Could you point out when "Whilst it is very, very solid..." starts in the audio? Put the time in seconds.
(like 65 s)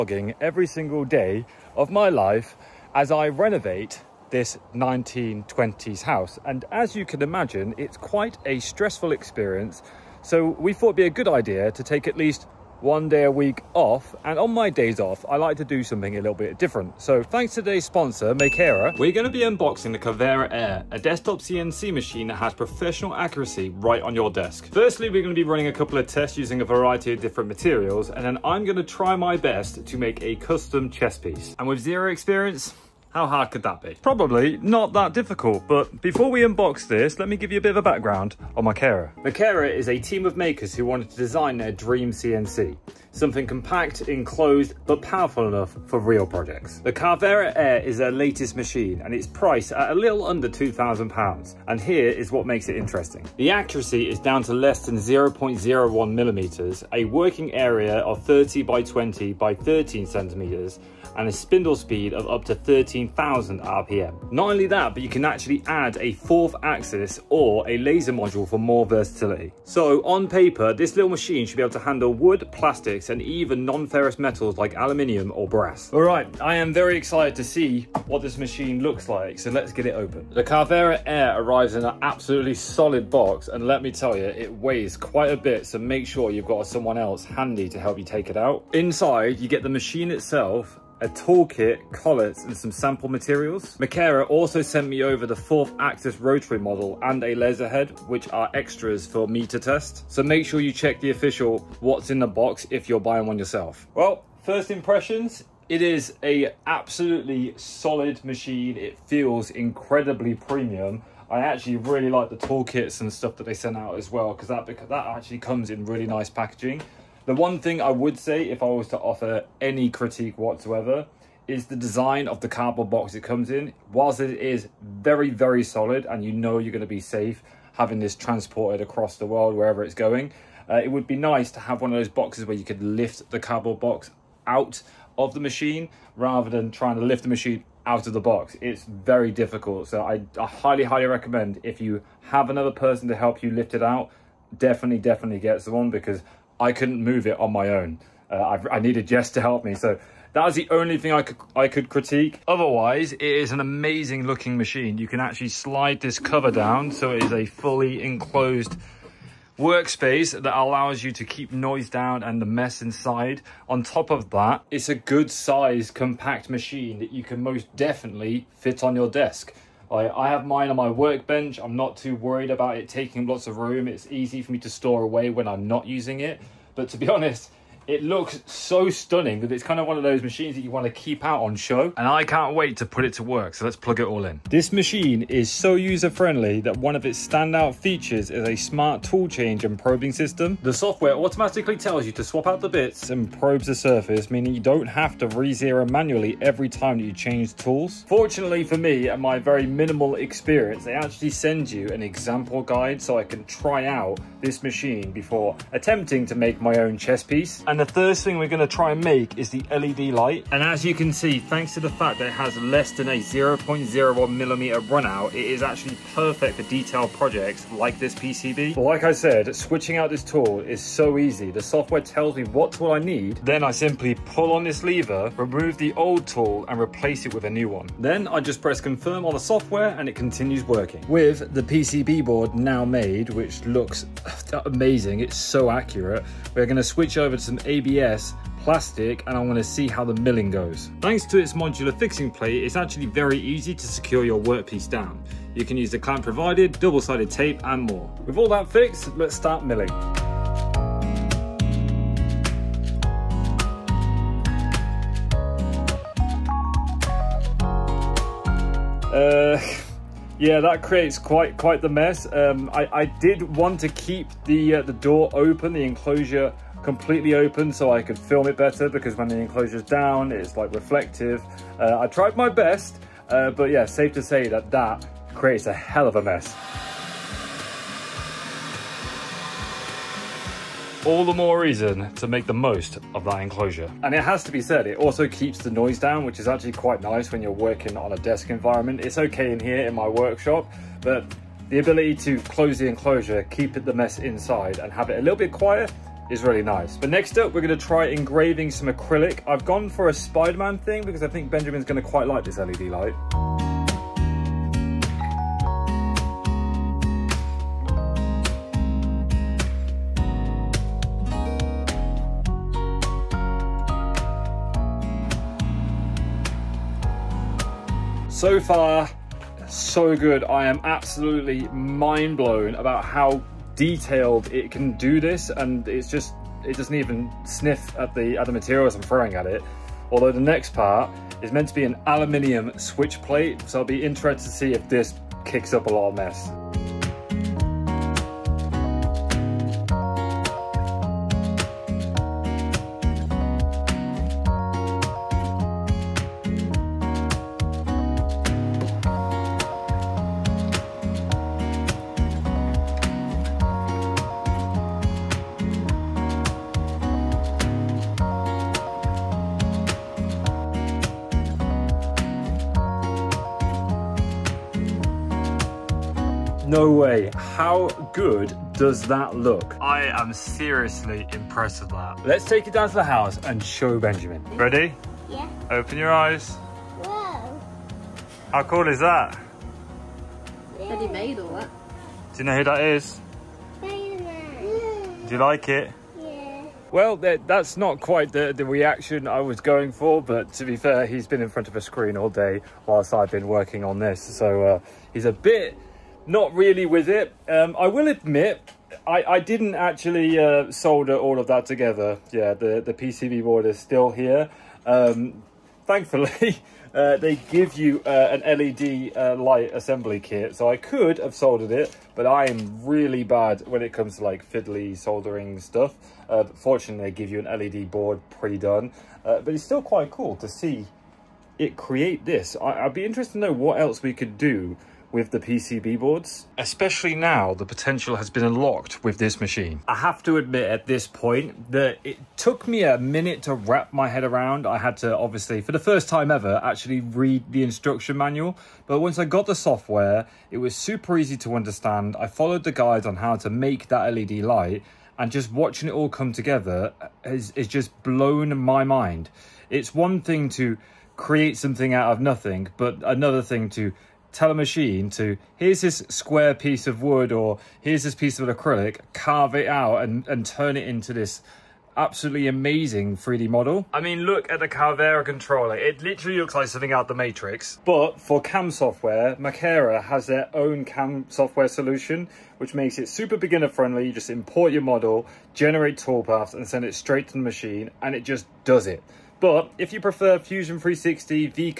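123 s.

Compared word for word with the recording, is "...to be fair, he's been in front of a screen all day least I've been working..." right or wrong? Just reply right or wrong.
wrong.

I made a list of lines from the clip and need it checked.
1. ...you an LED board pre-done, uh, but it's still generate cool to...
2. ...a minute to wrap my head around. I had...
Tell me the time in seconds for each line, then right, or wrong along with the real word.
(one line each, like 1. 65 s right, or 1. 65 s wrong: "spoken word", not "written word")
1. 417 s wrong: "quite", not "generate"
2. 432 s right.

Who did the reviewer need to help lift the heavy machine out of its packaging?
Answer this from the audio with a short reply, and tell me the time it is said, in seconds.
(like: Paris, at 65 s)
Jess, at 149 s.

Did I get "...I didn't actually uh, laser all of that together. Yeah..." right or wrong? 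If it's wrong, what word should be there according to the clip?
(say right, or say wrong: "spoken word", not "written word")
wrong: "solder", not "laser".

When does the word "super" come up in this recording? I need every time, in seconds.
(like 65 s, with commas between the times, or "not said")
440 s, 473 s.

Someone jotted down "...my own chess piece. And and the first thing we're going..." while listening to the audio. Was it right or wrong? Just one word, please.
right.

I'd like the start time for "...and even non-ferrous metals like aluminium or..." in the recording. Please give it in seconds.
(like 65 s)
73 s.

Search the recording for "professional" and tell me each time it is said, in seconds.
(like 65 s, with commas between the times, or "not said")
22 s.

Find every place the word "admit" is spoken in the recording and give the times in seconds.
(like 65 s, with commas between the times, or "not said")
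398 s, 430 s.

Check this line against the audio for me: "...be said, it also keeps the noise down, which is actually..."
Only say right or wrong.
right.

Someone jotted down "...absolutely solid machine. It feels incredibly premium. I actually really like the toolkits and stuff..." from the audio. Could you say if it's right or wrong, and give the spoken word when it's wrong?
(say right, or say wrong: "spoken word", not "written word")
right.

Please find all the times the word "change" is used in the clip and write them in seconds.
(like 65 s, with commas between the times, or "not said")
189 s, 197 s.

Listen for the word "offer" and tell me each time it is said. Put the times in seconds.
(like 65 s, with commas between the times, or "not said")
118 s.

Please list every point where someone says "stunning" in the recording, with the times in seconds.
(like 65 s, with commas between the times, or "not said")
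178 s.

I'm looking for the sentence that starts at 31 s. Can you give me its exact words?
And with zero experience, how hard could that be?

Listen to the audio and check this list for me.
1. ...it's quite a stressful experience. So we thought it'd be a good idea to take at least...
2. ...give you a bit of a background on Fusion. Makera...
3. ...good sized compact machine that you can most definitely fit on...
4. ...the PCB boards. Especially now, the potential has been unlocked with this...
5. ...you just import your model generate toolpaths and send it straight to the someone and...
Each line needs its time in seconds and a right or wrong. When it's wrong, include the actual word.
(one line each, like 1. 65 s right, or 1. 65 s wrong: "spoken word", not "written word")
1. 7 s right
2. 37 s wrong: "Makera", not "Fusion"
3. 164 s right
4. 425 s right
5. 474 s wrong: "machine", not "someone".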